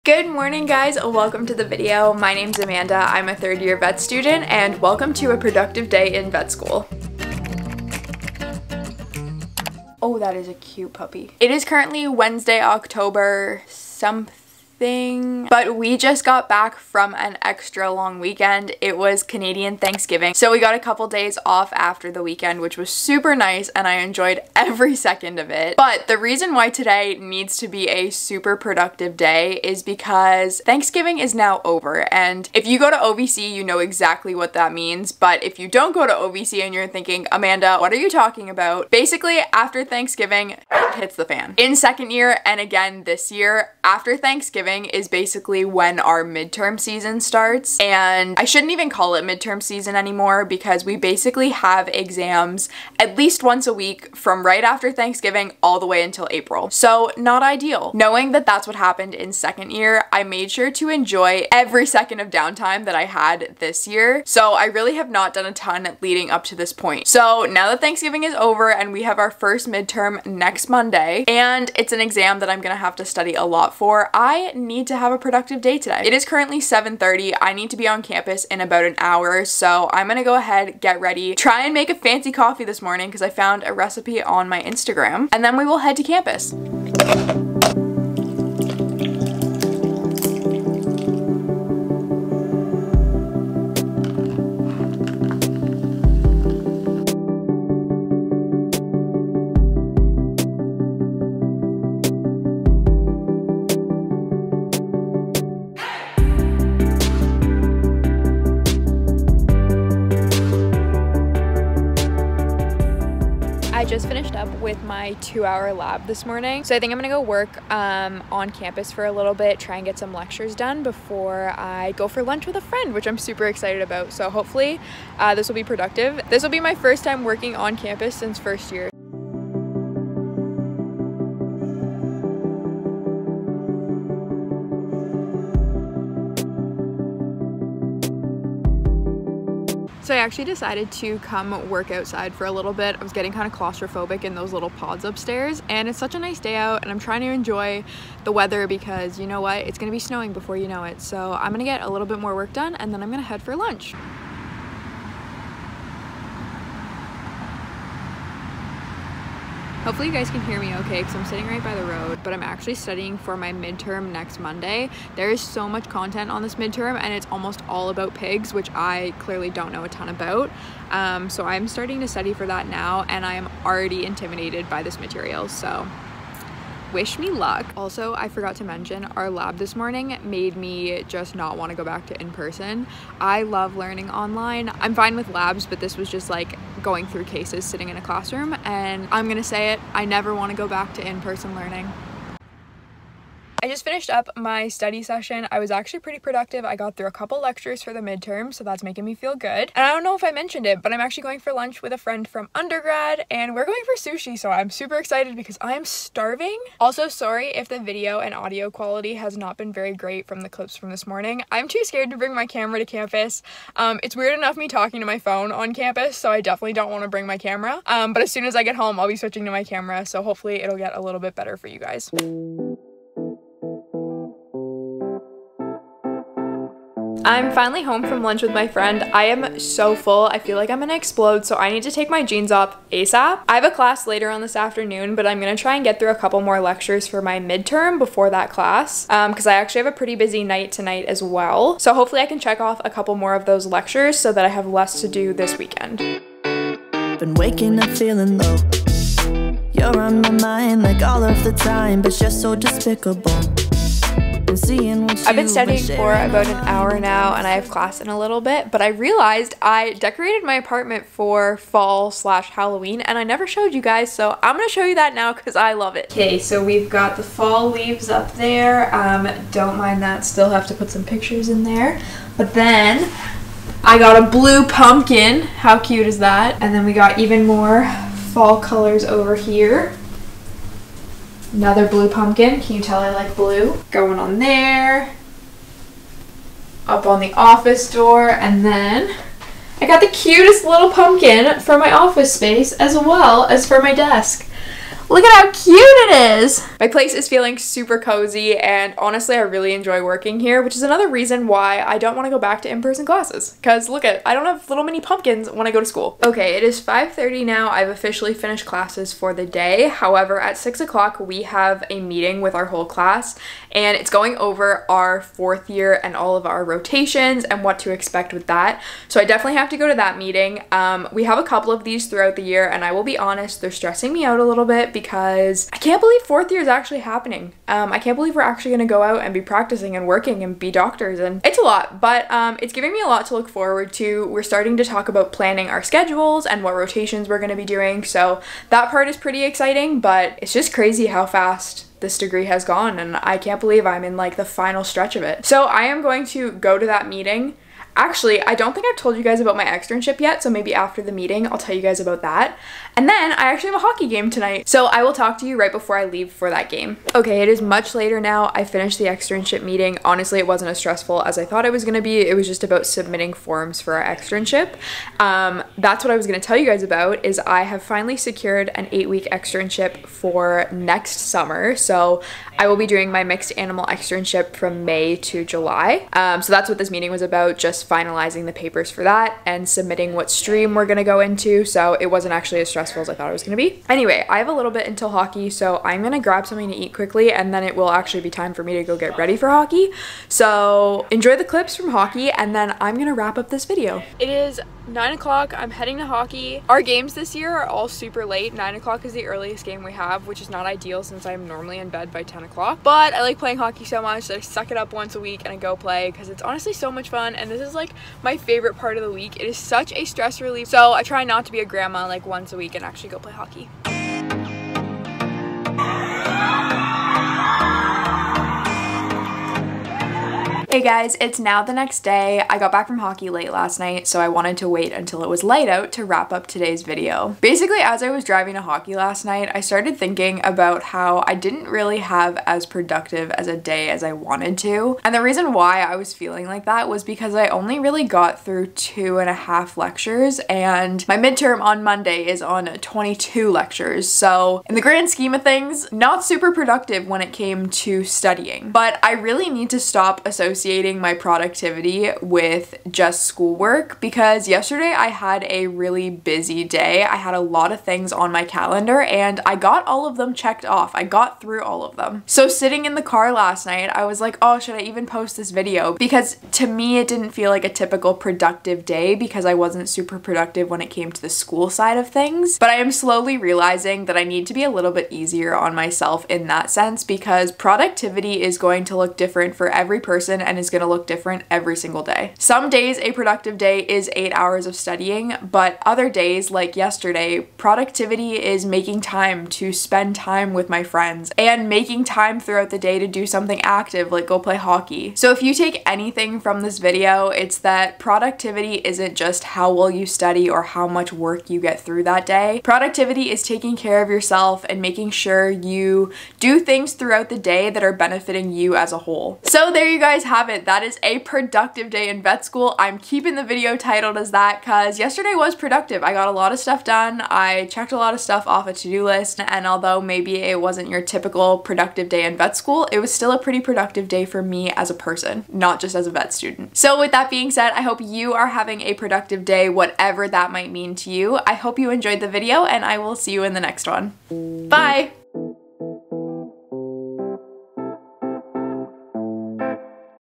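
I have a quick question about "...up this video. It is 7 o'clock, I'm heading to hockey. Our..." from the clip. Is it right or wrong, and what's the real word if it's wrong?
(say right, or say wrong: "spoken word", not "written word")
wrong: "9", not "7".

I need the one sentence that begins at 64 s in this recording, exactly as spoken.
So I really have not done a ton leading up to this point.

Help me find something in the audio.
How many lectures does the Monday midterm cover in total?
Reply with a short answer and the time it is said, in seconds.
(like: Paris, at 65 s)
22, at 442 s.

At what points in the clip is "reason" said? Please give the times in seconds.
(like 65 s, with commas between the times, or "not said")
26 s, 301 s, 435 s.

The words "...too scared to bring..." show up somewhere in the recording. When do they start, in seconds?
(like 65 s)
211 s.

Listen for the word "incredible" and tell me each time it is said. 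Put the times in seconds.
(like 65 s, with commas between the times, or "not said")
not said.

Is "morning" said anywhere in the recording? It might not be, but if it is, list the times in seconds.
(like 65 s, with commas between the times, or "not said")
0 s, 82 s, 116 s, 179 s, 211 s.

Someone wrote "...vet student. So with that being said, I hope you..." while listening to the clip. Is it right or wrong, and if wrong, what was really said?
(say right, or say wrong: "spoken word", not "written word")
right.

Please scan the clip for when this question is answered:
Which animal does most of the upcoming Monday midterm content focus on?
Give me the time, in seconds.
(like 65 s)
168 s.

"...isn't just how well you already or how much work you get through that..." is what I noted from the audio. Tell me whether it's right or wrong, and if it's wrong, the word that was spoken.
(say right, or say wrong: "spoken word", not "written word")
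wrong: "study", not "already".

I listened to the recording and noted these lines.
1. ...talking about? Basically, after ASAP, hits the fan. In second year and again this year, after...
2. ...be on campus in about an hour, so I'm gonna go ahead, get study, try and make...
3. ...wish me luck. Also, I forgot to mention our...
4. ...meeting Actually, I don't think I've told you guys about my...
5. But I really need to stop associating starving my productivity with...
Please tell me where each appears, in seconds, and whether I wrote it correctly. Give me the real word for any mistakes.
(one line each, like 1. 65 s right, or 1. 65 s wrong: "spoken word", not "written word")
1. 38 s wrong: "Thanksgiving", not "ASAP"
2. 77 s wrong: "ready", not "study"
3. 176 s right
4. 347 s right
5. 448 s wrong: "associating", not "starving".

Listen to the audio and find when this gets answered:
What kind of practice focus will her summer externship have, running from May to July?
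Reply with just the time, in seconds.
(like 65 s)
373 s.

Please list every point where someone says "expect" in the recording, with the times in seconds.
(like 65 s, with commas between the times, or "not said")
317 s.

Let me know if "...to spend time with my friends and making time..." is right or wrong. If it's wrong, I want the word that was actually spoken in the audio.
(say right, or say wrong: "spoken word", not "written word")
right.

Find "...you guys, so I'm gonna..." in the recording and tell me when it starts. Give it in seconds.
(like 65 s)
263 s.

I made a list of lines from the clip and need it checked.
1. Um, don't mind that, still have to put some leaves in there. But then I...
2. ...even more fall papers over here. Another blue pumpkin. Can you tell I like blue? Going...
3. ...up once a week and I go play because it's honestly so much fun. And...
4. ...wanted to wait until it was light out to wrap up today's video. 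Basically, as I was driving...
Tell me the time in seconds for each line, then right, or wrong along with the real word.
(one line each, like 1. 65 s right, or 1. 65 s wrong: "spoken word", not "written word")
1. 268 s wrong: "pictures", not "leaves"
2. 277 s wrong: "colors", not "papers"
3. 404 s right
4. 424 s right.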